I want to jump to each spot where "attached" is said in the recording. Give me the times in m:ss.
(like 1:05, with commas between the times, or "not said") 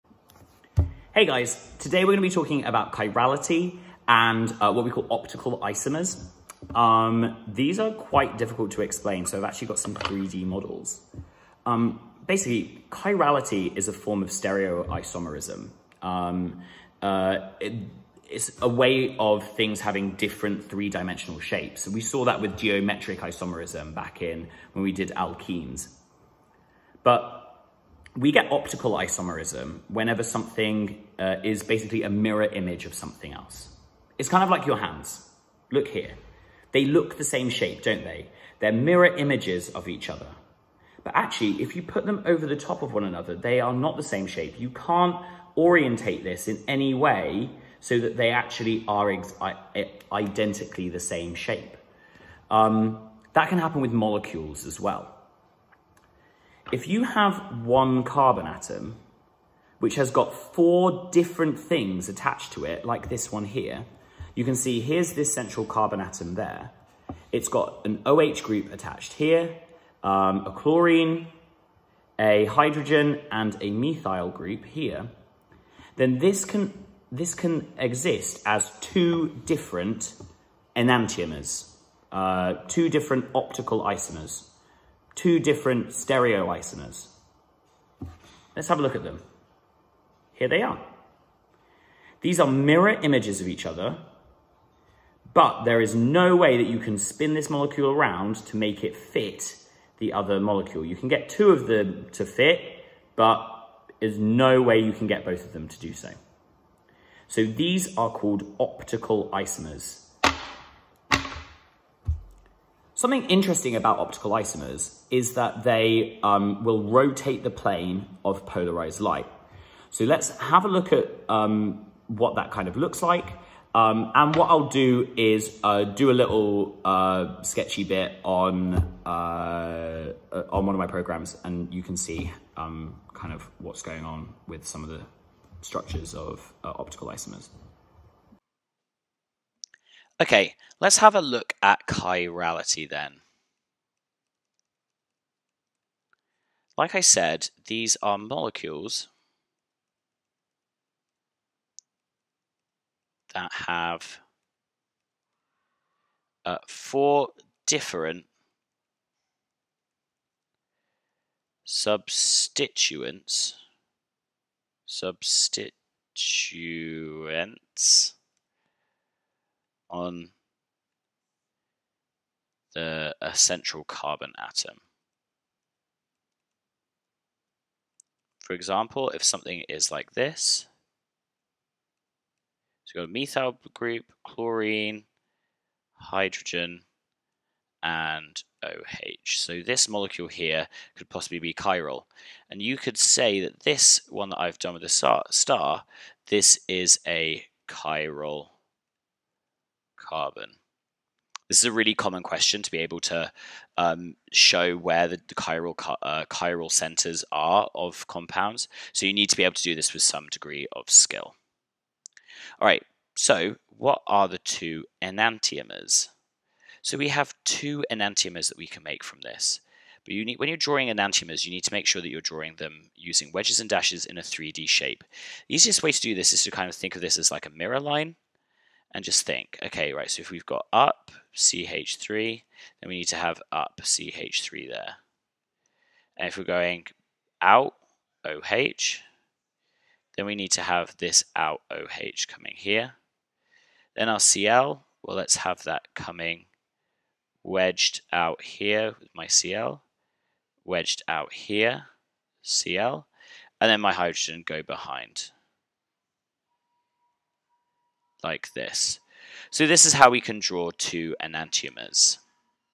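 1:02, 1:08.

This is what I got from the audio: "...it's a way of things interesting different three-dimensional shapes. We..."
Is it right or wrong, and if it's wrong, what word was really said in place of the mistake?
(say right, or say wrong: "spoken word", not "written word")
wrong: "having", not "interesting".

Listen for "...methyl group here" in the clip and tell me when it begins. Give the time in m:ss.
1:13.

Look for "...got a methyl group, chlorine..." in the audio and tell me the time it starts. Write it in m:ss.
3:03.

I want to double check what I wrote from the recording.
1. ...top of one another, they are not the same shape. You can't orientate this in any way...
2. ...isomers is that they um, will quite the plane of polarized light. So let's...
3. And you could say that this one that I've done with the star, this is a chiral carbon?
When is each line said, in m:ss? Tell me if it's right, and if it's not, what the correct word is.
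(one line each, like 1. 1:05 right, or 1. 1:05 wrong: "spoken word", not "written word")
1. 0:42 right
2. 1:54 wrong: "rotate", not "quite"
3. 3:12 right.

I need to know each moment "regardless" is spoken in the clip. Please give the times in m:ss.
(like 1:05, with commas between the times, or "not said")
not said.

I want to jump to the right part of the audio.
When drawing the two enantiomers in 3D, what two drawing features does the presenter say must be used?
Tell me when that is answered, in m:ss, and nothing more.
3:43.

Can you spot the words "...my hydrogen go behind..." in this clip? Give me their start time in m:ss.
4:13.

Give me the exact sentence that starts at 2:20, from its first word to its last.
Okay, let's have a look at chirality then.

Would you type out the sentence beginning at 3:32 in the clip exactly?
All right, so what are the two enantiomers?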